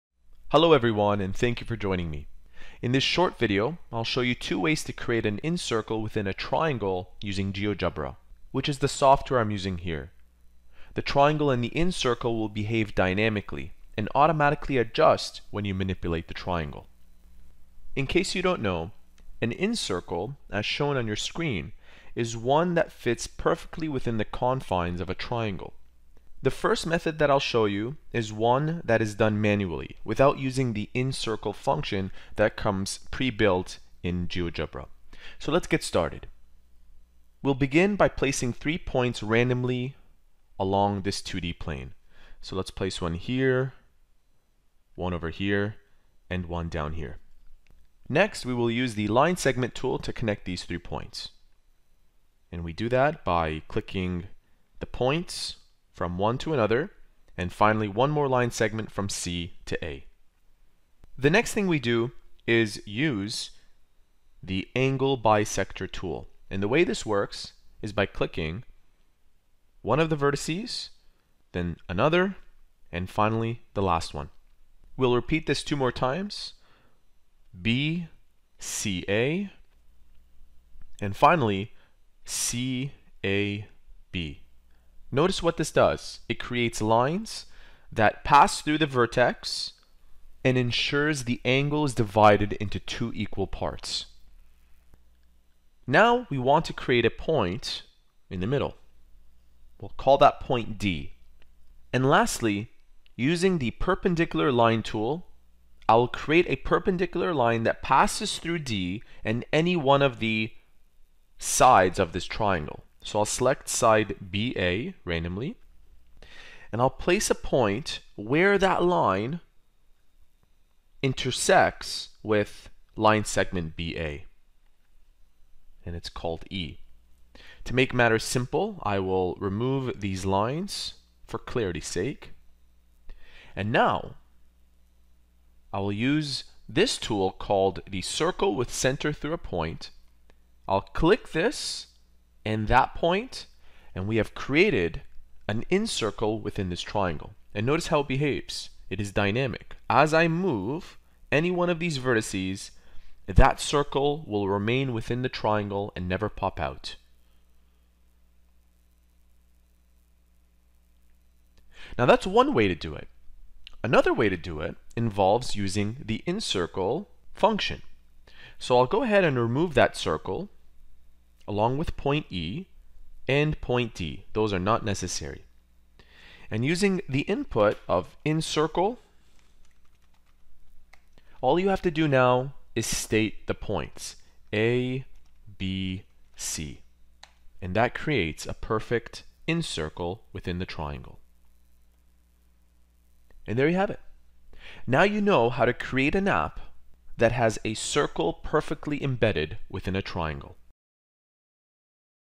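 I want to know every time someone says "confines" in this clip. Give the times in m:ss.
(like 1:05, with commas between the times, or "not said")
0:24.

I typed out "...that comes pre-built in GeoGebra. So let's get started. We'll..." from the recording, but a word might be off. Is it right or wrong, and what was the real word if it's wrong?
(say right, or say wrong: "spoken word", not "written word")
right.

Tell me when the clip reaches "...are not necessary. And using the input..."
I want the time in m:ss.
2:54.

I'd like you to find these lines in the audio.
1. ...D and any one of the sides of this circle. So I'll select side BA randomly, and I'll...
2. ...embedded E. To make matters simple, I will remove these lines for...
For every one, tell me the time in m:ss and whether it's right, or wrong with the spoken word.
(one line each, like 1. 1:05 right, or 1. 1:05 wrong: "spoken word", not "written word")
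1. 1:48 wrong: "triangle", not "circle"
2. 2:06 wrong: "called", not "embedded".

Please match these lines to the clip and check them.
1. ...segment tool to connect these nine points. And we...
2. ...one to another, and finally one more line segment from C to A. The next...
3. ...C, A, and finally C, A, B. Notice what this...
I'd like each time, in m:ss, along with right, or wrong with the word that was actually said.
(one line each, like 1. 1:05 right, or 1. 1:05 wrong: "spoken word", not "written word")
1. 0:49 wrong: "three", not "nine"
2. 0:56 right
3. 1:18 right.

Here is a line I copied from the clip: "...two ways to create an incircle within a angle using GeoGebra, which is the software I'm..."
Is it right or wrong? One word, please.
wrong.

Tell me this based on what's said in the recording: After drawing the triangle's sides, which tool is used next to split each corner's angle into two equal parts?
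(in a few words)
angle bisector tool.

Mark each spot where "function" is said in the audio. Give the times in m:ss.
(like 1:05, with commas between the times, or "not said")
0:31, 2:47.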